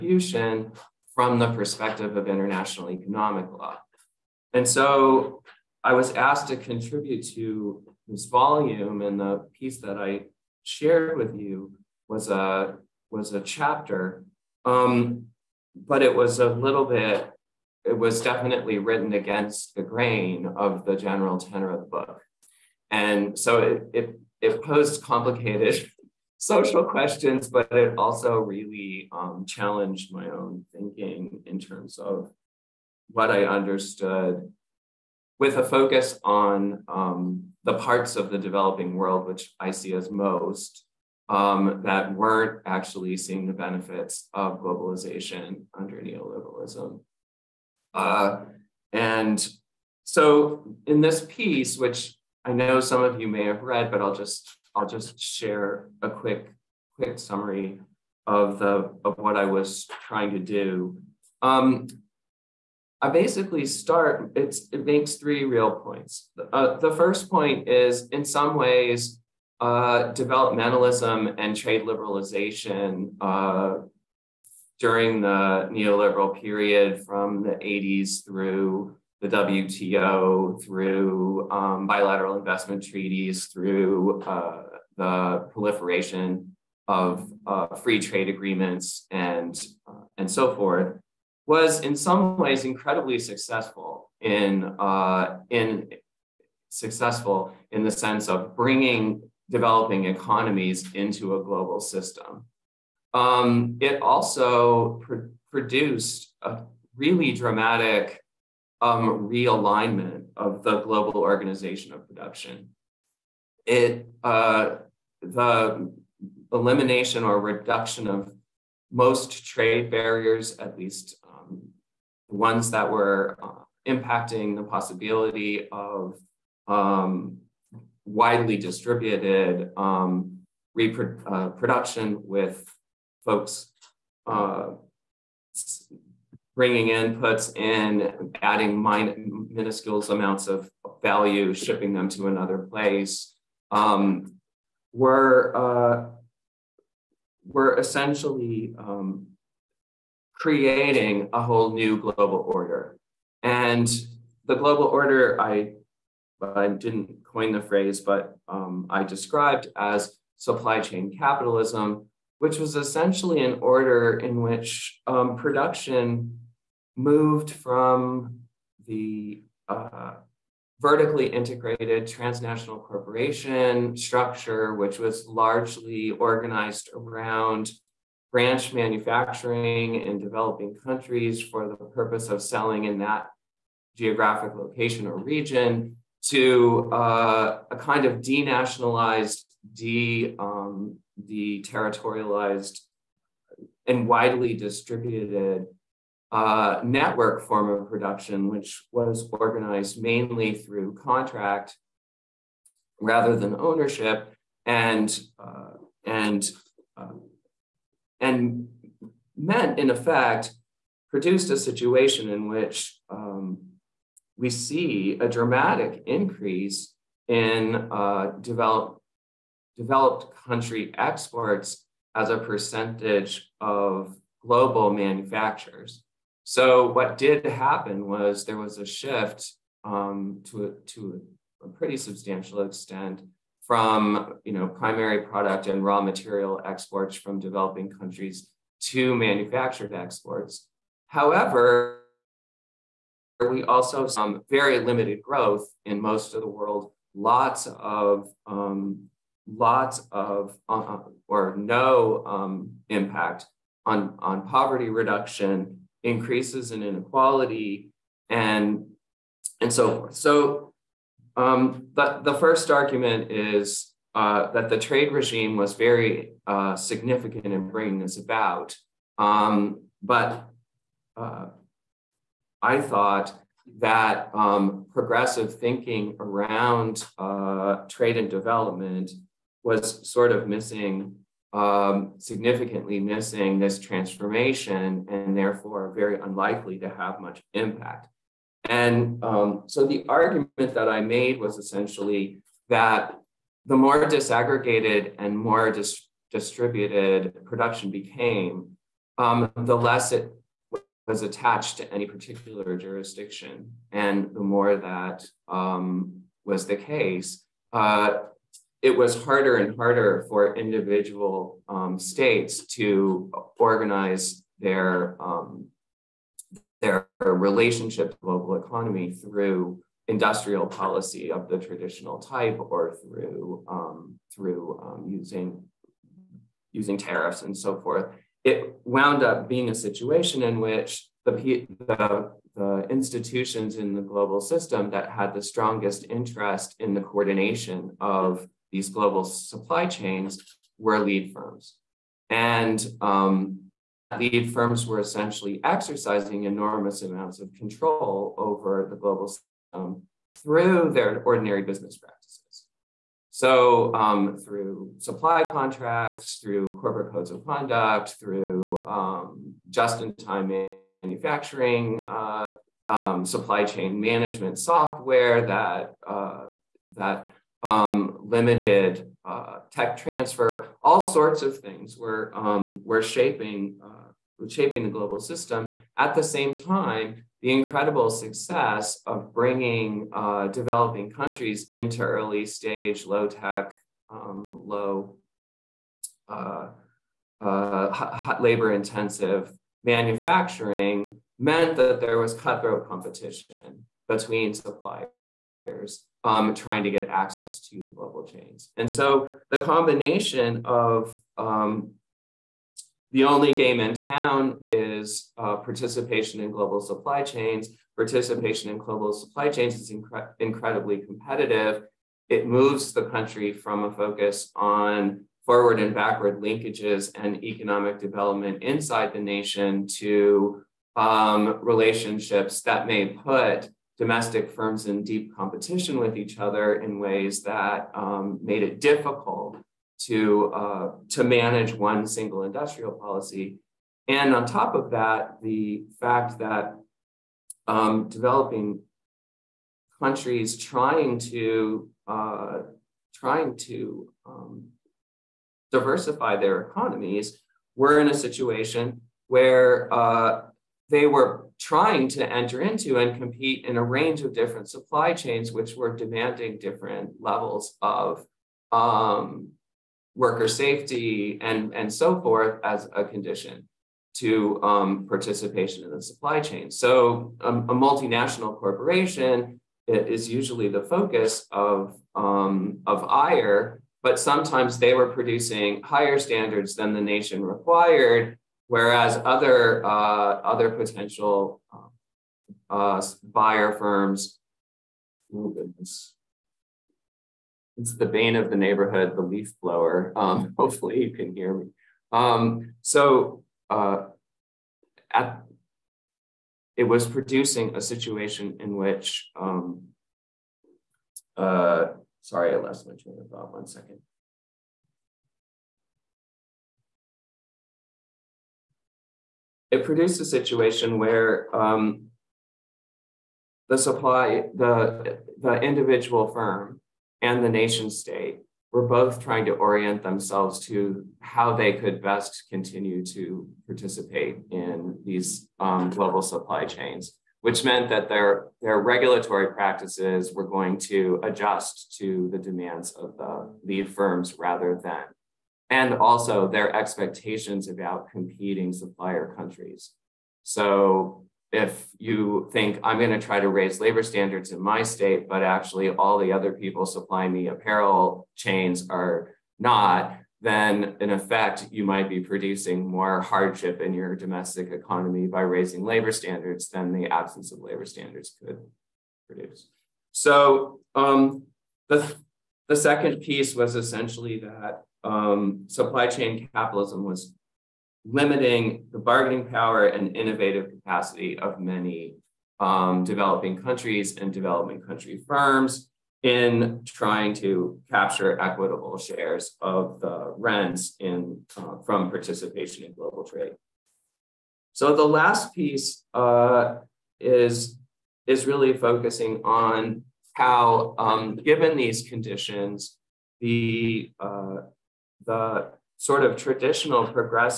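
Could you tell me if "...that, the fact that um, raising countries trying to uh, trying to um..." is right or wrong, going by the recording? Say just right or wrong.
wrong.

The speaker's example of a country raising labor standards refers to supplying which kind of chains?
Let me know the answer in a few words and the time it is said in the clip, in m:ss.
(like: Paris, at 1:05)
apparel chains, at 9:07.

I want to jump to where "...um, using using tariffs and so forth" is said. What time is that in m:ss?
5:24.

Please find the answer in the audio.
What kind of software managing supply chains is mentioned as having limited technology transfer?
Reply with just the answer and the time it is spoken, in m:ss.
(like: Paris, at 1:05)
supply chain management software, at 6:03.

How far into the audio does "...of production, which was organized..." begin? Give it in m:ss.
3:17.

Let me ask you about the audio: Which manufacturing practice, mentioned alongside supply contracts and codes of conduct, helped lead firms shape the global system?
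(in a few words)
just in time manufacturing.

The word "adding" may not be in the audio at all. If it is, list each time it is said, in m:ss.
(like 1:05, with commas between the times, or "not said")
2:18.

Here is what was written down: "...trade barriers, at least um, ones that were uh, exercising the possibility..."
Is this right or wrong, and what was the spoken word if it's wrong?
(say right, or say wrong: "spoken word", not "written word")
wrong: "impacting", not "exercising".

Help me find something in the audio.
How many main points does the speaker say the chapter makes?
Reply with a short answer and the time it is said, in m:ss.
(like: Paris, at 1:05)
3, at 1:05.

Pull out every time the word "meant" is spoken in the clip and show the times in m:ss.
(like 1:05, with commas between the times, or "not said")
3:29, 6:31, 8:47.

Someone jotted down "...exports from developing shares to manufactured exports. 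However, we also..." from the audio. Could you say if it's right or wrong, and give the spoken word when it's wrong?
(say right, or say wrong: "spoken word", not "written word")
wrong: "countries", not "shares".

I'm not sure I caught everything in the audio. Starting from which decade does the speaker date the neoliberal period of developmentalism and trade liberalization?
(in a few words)
the 80s.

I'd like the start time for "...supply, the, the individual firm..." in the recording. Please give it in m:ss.
8:33.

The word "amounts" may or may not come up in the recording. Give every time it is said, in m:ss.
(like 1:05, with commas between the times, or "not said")
2:20, 5:47.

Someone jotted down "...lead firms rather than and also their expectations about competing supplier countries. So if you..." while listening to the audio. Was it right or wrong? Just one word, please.
right.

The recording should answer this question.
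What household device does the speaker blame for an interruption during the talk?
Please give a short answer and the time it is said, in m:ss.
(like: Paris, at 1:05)
the leaf blower, at 8:09.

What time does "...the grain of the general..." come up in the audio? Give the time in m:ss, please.
0:19.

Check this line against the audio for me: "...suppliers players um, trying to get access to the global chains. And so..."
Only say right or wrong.
right.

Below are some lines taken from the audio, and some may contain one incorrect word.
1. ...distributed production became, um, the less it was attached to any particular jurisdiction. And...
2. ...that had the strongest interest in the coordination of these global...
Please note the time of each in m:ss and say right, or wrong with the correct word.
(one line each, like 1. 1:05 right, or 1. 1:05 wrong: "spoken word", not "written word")
1. 4:56 right
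2. 5:34 right.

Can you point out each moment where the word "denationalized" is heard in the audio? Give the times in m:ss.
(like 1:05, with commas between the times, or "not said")
3:08.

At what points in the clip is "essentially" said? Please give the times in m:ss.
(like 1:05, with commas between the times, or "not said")
2:27, 2:42, 4:51, 5:44, 9:23.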